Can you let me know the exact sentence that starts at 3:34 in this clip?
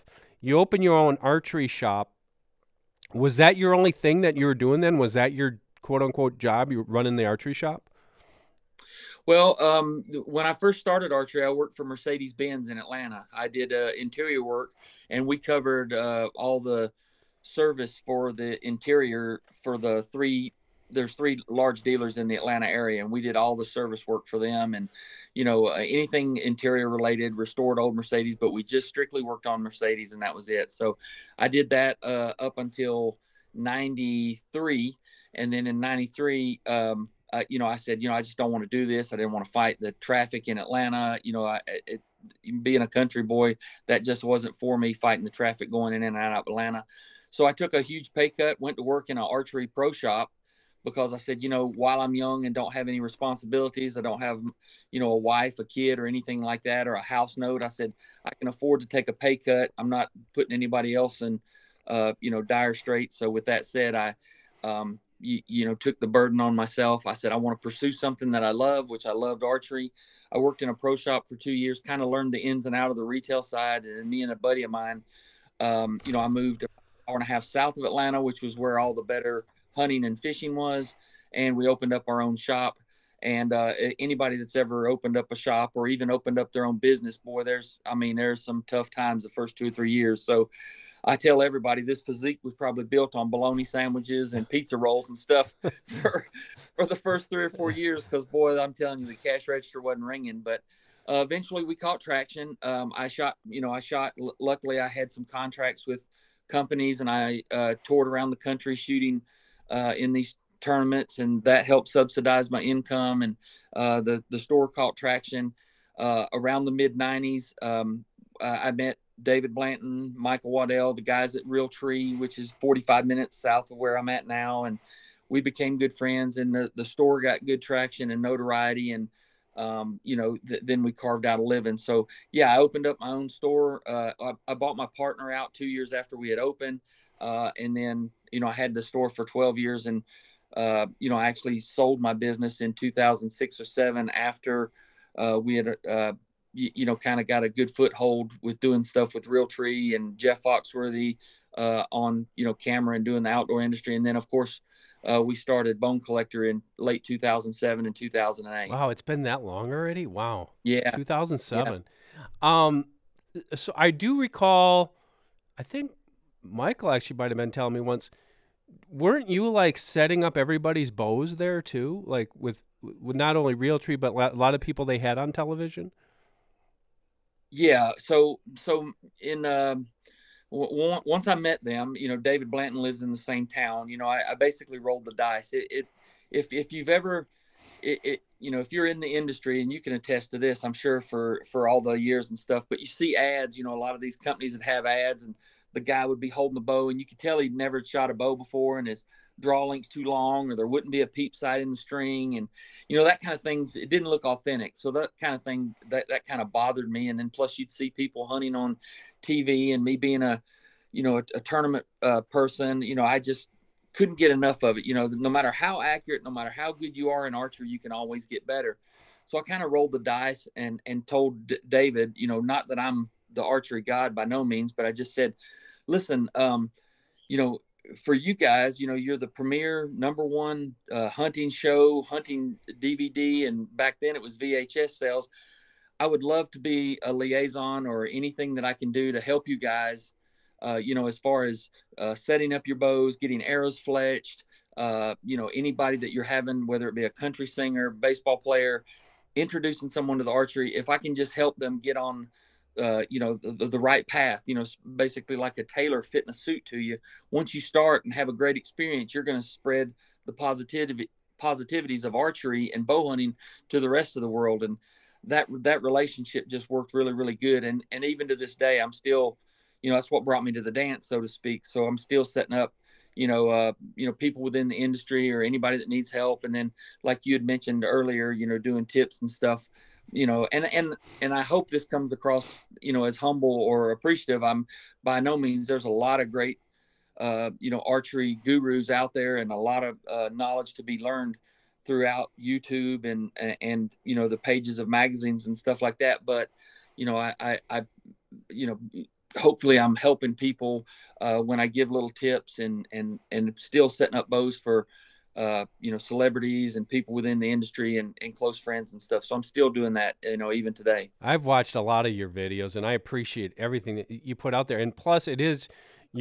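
You know, no matter how accurate, no matter how good you are in archery, you can always get better.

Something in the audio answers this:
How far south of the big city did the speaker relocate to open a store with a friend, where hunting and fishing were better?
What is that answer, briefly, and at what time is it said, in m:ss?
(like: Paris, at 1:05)
An hour and a half, at 1:16.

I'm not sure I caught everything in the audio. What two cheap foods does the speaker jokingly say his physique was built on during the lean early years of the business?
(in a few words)
Bologna sandwiches and pizza rolls.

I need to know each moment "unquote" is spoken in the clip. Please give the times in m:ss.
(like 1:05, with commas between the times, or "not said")
0:06.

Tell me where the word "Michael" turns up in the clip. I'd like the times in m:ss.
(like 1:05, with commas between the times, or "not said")
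2:00, 2:46.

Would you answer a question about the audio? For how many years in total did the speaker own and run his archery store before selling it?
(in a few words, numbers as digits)
12.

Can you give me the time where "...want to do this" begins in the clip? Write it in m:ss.
0:38.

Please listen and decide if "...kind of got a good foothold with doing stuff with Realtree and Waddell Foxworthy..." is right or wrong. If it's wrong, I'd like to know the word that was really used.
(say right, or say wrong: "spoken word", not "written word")
wrong: "Jeff", not "Waddell".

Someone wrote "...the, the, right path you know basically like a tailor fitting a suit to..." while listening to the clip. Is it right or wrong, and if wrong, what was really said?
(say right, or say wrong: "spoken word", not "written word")
right.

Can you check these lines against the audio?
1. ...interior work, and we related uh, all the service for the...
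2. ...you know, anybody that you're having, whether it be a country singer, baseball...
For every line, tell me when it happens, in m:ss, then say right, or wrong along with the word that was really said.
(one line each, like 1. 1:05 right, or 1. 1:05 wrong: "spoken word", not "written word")
1. 0:13 wrong: "covered", not "related"
2. 4:05 right.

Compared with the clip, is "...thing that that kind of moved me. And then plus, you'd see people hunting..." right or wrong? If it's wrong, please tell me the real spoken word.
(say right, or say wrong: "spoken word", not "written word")
wrong: "bothered", not "moved".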